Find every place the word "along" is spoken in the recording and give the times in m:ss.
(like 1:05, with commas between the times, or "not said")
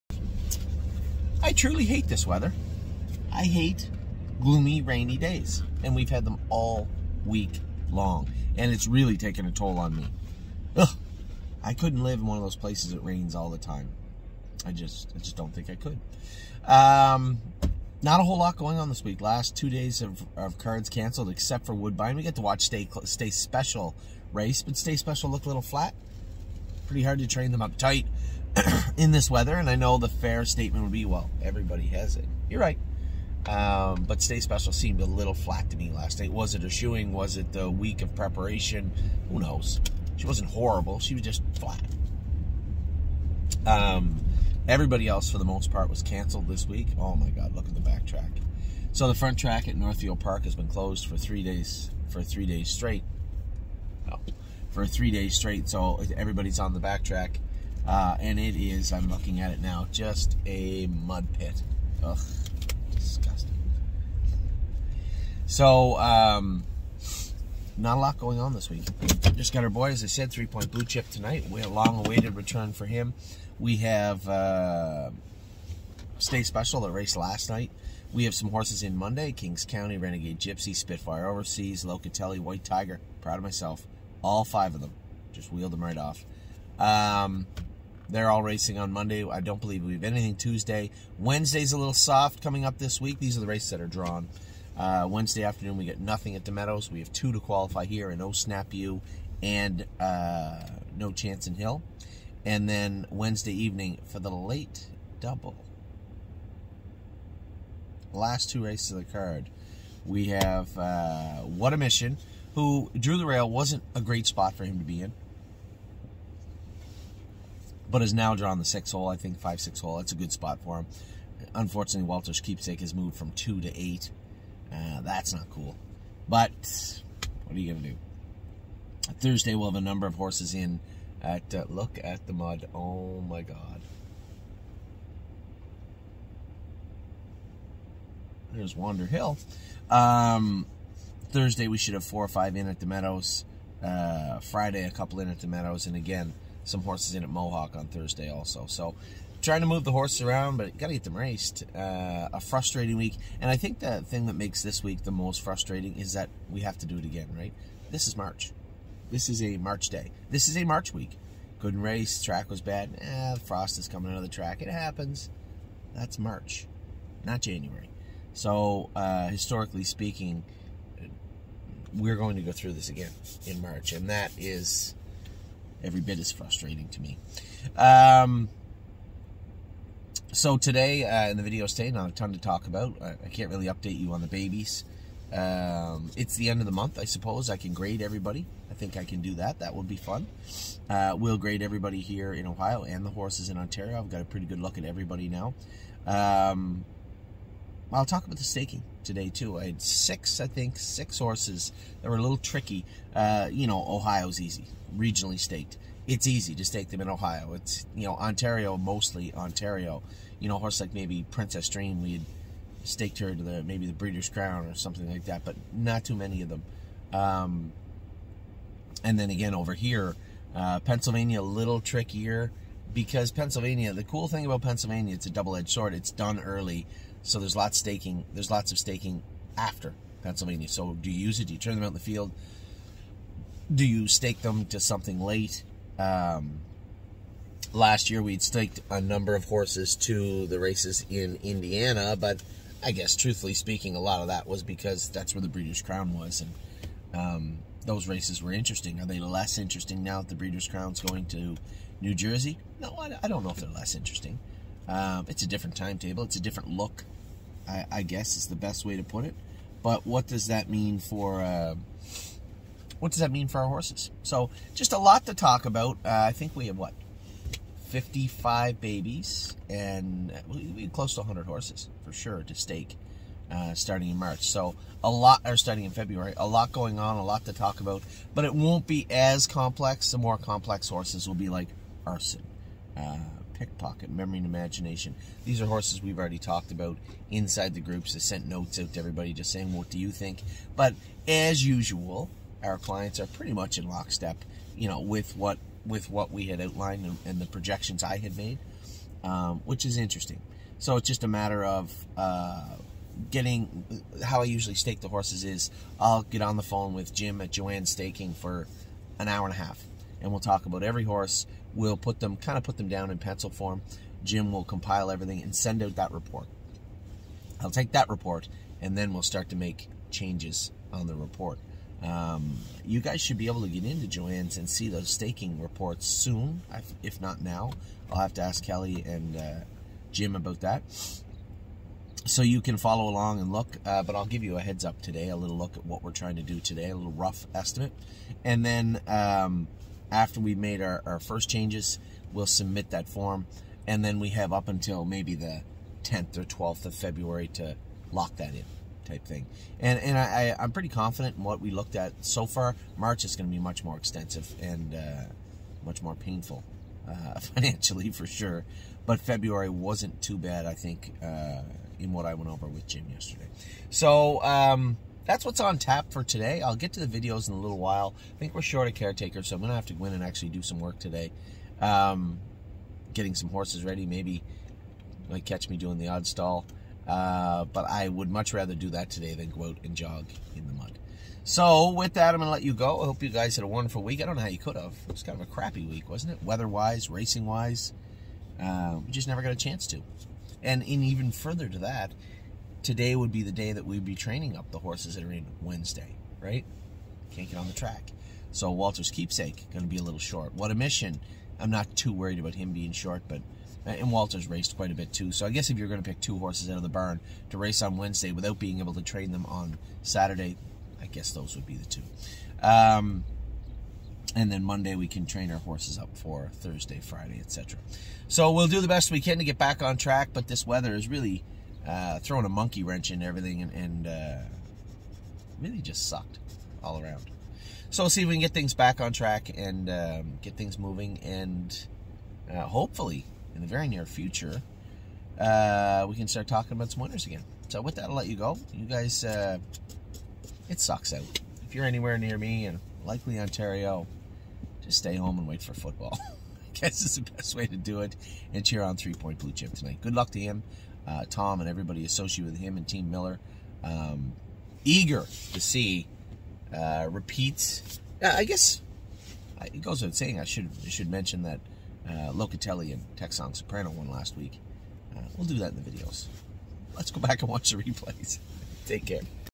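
5:33.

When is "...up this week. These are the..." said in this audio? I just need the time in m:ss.
1:32.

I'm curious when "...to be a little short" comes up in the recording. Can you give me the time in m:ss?
6:39.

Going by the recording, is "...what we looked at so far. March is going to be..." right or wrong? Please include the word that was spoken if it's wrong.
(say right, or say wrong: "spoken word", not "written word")
right.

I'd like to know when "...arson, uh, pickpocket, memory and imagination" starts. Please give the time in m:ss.
4:42.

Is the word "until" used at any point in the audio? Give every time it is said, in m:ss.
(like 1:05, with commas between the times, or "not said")
5:44.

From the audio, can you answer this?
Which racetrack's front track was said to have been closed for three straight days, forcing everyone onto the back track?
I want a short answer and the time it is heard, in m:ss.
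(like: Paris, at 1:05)
Northfield Park, at 0:49.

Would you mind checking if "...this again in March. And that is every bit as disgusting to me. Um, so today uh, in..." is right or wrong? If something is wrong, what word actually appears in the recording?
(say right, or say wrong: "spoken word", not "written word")
wrong: "frustrating", not "disgusting".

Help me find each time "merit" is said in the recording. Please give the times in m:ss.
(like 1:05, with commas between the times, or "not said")
not said.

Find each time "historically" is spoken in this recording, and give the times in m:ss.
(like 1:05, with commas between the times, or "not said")
2:49.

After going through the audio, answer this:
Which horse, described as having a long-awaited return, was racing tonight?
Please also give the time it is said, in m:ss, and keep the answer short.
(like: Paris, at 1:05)
Three Point Blue Chip, at 1:10.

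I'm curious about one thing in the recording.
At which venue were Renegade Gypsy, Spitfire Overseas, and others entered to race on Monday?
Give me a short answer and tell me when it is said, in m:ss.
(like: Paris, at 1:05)
Kings County, at 1:19.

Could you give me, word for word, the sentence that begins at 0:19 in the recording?
Last two days of, of cards canceled except for Woodbine.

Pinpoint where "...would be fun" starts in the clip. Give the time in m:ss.
3:09.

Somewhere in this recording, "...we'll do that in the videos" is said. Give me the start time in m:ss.
7:45.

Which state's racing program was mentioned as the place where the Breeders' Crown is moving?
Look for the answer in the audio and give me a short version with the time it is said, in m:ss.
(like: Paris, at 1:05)
New Jersey, at 4:12.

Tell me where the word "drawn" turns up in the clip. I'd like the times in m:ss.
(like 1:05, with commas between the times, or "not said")
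1:33, 1:58.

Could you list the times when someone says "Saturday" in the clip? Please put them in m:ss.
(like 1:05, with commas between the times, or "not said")
6:50.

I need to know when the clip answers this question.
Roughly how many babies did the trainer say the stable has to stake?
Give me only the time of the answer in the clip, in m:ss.
4:27.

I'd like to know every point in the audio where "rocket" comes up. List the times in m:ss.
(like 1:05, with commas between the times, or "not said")
not said.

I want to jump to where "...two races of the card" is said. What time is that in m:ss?
1:48.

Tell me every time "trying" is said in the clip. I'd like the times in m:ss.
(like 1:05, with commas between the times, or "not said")
2:29, 5:36.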